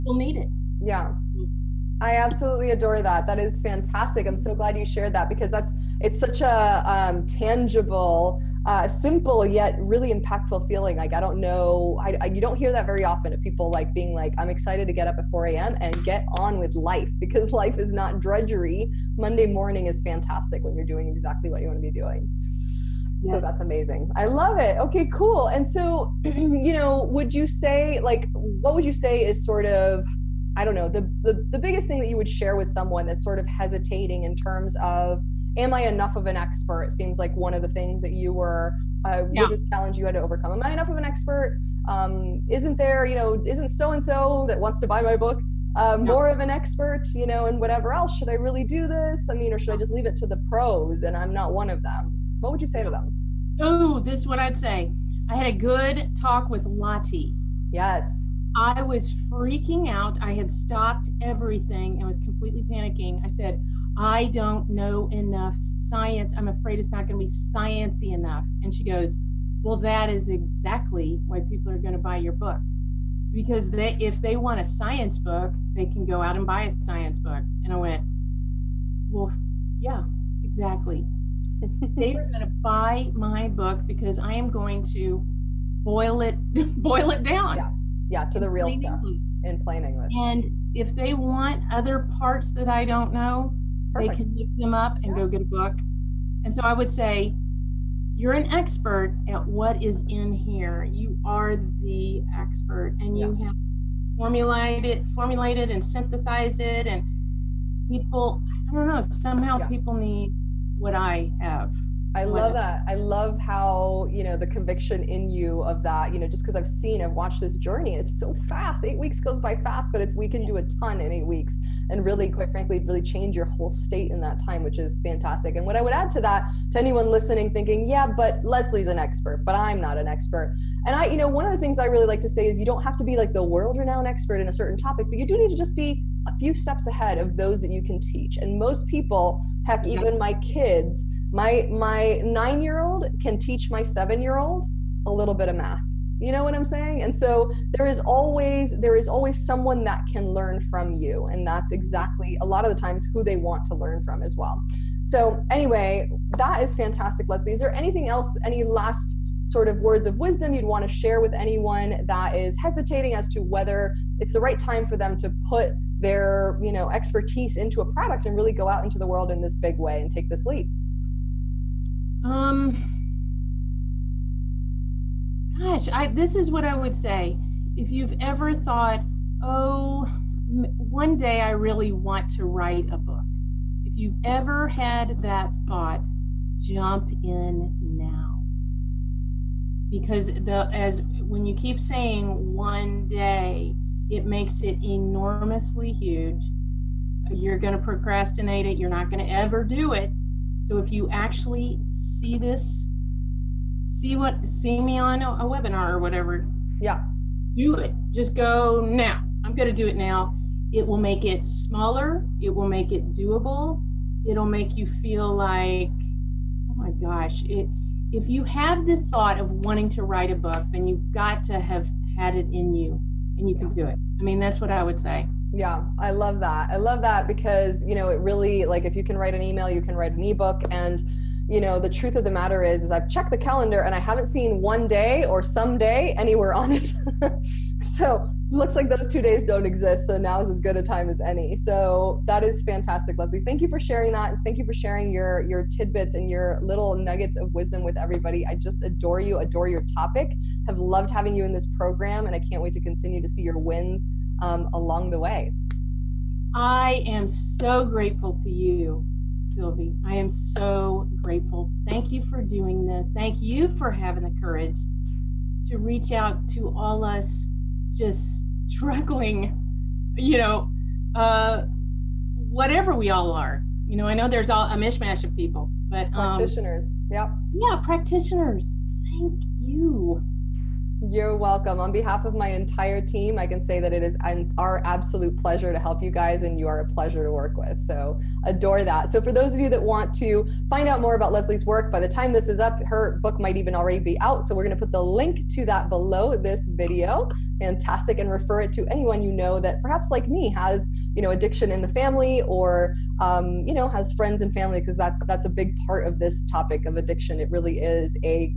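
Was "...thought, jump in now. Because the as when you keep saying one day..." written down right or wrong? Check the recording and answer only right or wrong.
right.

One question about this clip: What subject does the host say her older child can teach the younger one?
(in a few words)
math.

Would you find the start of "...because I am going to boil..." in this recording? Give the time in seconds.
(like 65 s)
83 s.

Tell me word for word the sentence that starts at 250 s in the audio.
Have loved having you in this program and I can't wait to continue to see your wins um, along the way.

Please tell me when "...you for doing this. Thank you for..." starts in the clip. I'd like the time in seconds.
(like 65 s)
262 s.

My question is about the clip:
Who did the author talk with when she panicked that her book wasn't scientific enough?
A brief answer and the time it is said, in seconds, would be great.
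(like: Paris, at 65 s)
Lottie, at 56 s.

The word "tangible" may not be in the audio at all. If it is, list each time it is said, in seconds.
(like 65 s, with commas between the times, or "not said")
7 s.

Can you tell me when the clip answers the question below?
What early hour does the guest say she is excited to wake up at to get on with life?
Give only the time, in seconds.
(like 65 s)
15 s.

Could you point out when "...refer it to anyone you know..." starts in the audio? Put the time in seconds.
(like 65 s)
298 s.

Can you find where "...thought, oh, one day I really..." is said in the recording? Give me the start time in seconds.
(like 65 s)
178 s.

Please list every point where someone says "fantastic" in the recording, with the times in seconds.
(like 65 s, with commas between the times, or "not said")
3 s, 20 s, 125 s, 156 s, 242 s, 297 s.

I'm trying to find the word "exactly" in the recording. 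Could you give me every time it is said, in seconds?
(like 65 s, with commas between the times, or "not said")
21 s, 70 s, 80 s, 151 s.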